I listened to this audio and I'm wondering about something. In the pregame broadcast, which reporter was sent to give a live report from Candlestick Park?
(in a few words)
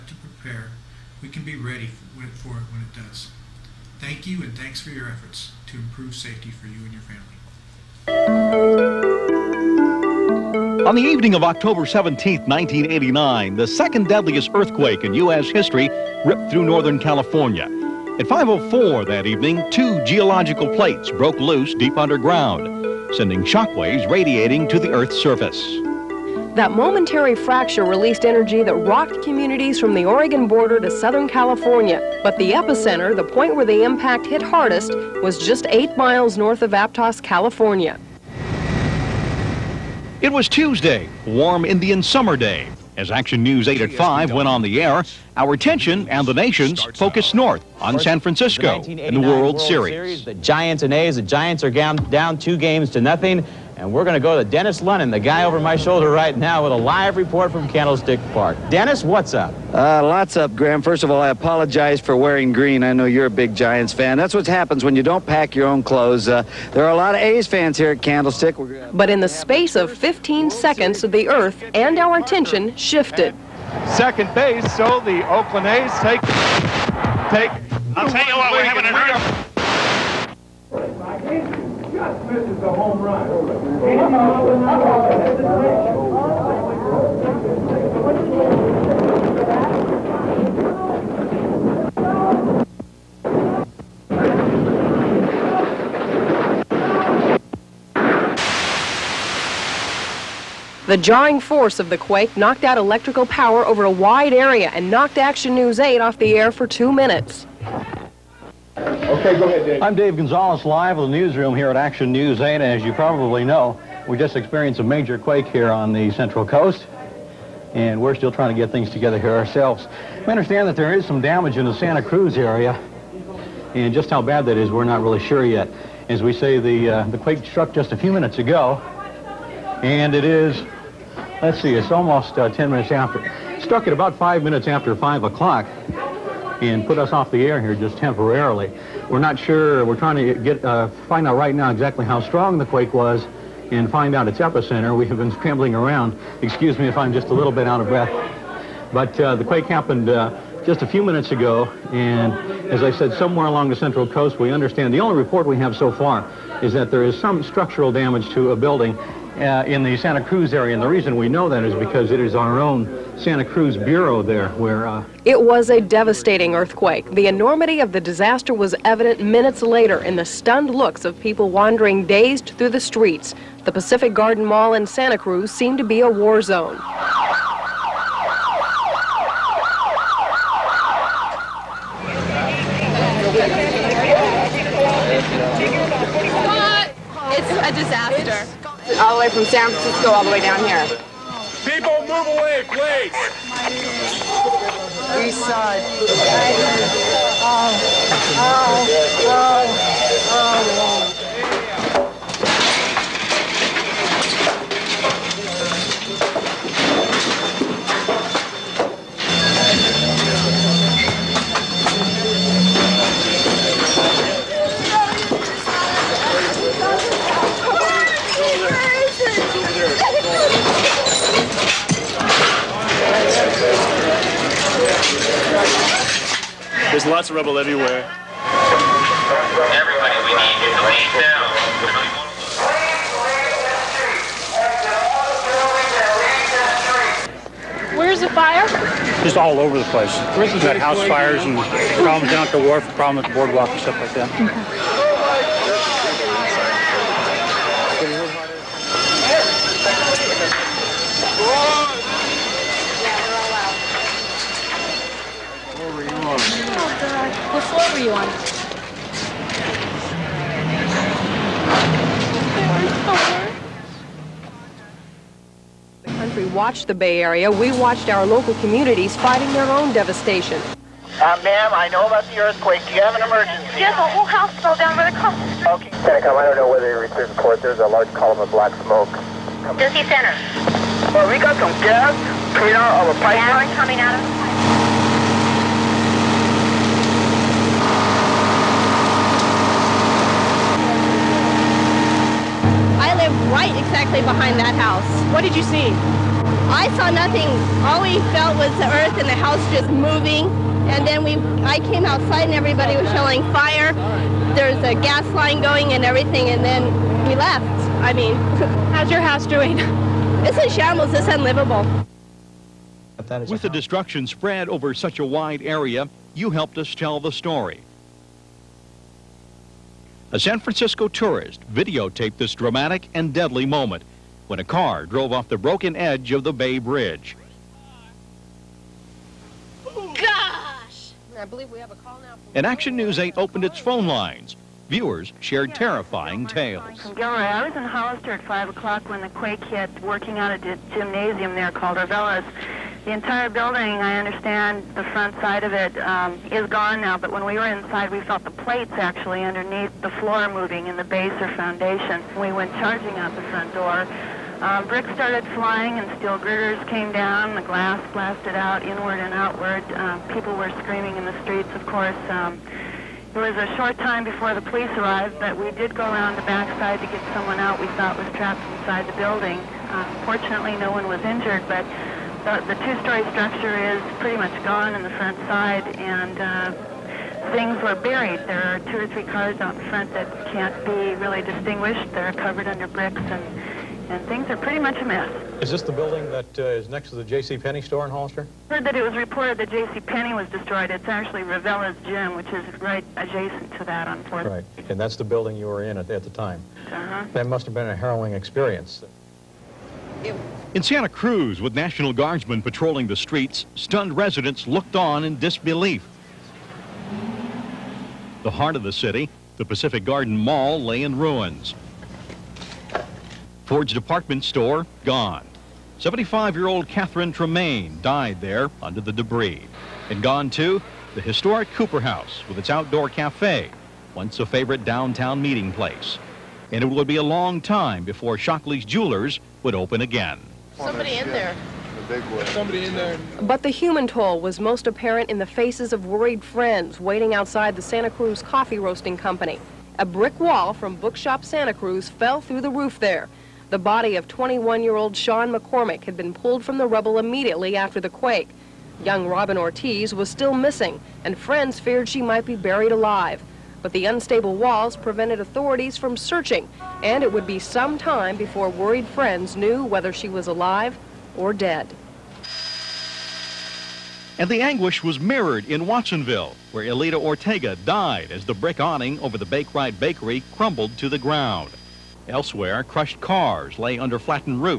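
Dennis Lennon.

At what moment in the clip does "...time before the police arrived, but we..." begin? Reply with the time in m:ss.
6:03.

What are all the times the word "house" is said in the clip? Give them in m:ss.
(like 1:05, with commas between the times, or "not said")
4:00, 4:34, 4:54, 4:59, 5:09, 7:01.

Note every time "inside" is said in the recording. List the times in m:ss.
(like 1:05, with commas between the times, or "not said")
5:47, 6:08.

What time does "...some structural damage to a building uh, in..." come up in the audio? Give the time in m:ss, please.
2:37.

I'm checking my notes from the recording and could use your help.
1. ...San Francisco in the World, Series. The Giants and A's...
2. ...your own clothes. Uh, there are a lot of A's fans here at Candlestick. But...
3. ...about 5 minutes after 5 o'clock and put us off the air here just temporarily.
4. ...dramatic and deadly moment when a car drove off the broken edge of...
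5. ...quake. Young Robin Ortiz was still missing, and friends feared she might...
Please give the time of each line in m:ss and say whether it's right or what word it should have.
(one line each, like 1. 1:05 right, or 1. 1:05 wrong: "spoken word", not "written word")
1. 0:47 right
2. 1:05 right
3. 2:13 right
4. 5:22 right
5. 7:28 right.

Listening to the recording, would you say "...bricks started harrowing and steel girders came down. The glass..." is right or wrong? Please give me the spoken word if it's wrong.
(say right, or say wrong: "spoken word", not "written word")
wrong: "flying", not "harrowing".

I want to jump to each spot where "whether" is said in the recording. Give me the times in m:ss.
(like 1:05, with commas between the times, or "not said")
4:36, 7:39.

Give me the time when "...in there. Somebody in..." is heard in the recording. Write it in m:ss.
7:11.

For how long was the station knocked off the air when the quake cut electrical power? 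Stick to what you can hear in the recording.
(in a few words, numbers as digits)
2 minutes.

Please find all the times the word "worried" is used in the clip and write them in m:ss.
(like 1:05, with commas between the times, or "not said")
7:16, 7:38.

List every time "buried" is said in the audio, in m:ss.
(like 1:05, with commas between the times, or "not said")
6:17, 7:32.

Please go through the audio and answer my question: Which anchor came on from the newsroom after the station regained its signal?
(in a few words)
Dave Gonzalez.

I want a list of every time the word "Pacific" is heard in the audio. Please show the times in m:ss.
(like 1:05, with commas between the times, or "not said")
2:53, 6:49.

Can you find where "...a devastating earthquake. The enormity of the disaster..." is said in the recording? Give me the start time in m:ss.
2:45.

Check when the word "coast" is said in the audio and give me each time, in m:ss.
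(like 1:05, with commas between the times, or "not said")
1:56, 2:34.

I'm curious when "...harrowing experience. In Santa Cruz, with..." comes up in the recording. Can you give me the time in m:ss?
6:37.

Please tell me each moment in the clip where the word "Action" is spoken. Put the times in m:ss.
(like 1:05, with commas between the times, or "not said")
0:43, 1:45, 1:51, 5:32.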